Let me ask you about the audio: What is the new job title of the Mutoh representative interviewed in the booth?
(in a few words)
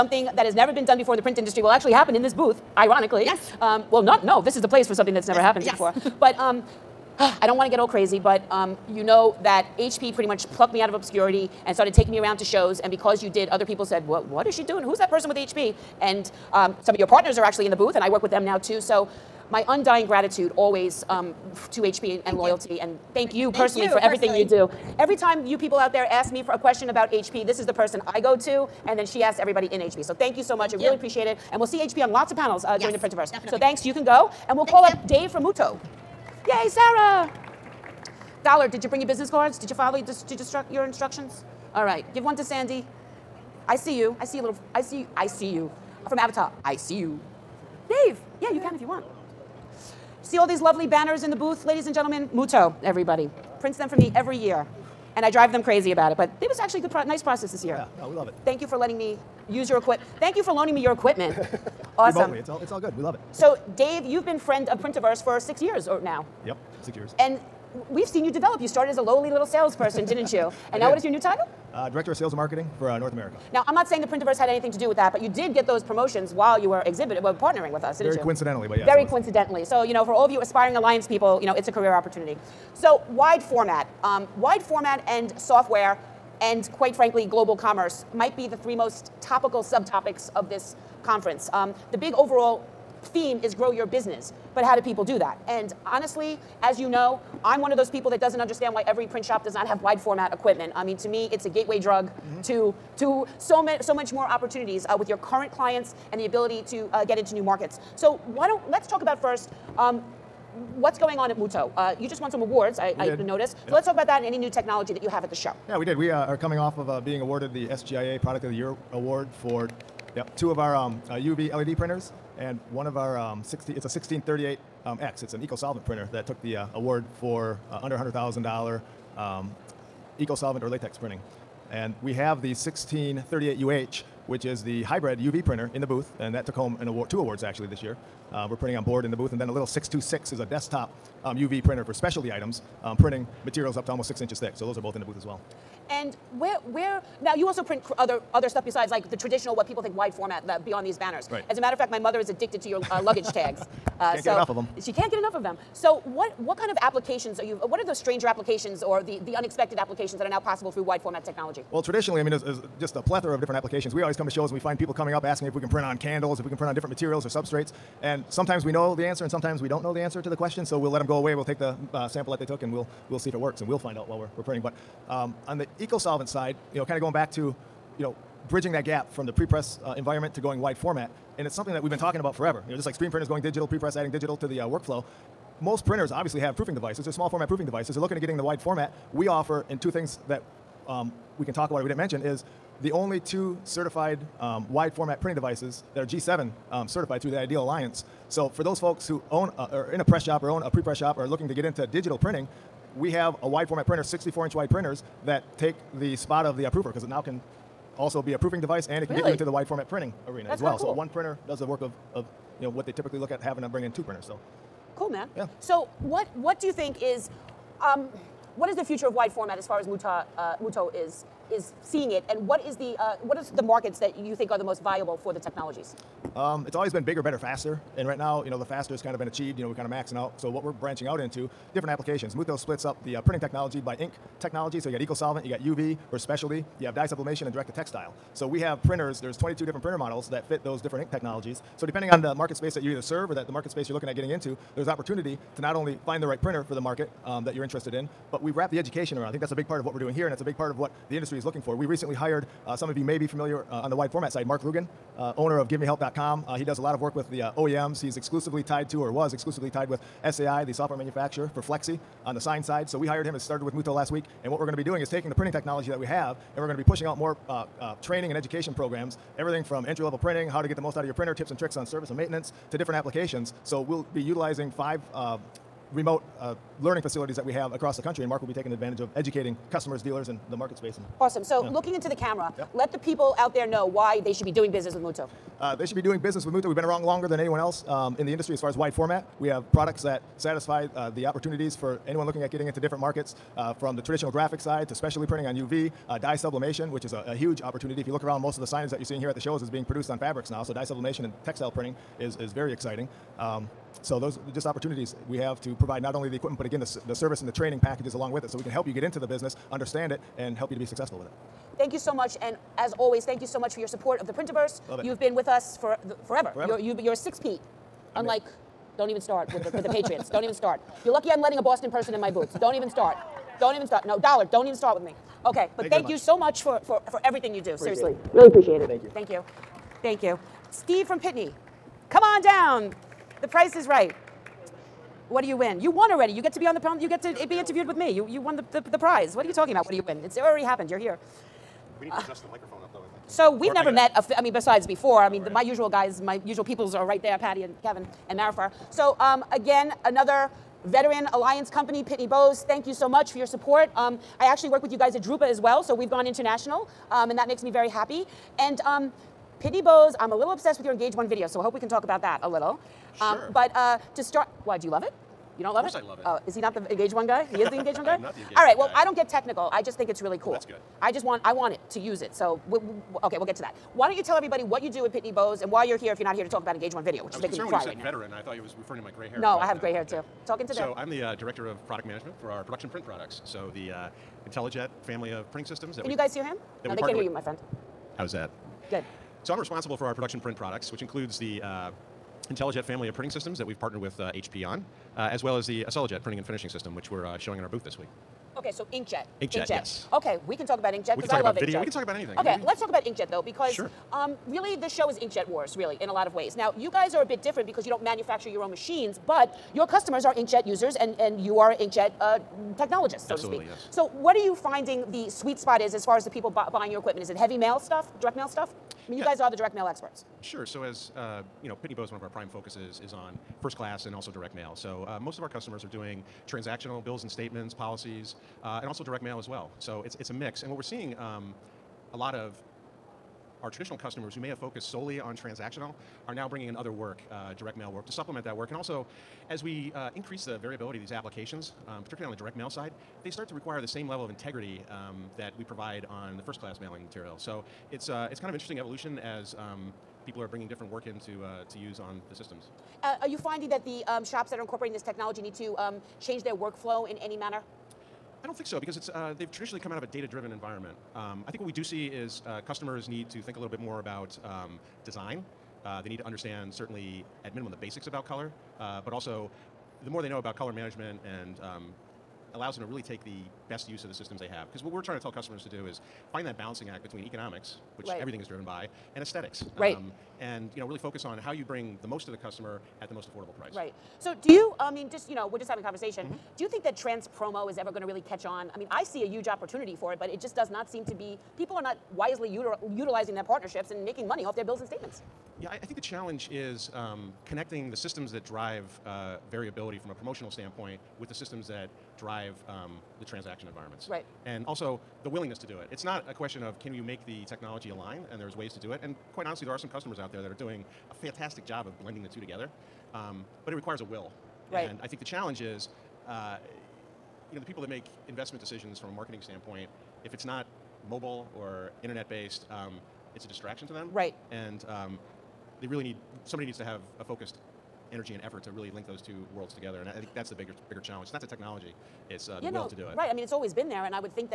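Director of Sales and Marketing.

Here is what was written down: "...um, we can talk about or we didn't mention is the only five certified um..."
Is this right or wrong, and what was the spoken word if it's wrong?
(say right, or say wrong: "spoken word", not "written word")
wrong: "two", not "five".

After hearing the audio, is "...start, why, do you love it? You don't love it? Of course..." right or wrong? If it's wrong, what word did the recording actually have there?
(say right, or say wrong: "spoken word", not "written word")
right.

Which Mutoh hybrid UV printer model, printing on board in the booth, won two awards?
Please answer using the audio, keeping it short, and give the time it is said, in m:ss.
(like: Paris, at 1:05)
1638UH, at 2:12.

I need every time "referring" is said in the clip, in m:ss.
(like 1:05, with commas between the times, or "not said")
6:18.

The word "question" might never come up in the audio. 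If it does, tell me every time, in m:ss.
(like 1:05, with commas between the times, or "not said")
0:26, 2:50, 8:26.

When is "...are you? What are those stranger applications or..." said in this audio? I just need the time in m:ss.
2:37.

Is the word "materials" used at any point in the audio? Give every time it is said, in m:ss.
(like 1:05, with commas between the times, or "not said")
2:23, 2:46, 7:27.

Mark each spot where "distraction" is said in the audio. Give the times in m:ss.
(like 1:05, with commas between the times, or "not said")
8:43.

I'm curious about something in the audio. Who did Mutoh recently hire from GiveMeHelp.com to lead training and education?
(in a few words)
Mark Rugen.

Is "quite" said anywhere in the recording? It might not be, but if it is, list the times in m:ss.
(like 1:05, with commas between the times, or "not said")
1:26, 8:29.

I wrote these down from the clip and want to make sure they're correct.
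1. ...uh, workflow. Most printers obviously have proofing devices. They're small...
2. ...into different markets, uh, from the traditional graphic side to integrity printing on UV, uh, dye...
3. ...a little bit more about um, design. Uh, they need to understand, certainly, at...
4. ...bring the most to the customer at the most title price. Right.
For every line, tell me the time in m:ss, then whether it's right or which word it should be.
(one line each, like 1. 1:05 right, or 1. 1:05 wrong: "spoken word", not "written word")
1. 3:04 right
2. 4:52 wrong: "specialty", not "integrity"
3. 7:43 right
4. 8:01 wrong: "affordable", not "title".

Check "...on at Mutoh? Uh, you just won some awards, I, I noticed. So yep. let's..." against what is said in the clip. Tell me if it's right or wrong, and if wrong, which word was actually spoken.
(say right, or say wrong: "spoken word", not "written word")
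right.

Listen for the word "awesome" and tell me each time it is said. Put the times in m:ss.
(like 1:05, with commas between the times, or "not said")
1:01, 4:41.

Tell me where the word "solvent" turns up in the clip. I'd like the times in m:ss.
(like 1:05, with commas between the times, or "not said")
2:05, 2:10, 2:55, 3:55.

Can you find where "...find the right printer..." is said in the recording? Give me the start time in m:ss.
4:06.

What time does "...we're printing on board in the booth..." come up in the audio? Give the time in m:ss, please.
2:18.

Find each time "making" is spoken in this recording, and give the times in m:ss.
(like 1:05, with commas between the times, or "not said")
6:17, 8:14.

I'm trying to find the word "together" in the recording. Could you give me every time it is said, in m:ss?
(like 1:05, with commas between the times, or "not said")
8:32, 8:49.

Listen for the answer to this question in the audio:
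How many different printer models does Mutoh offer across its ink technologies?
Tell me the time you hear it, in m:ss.
3:59.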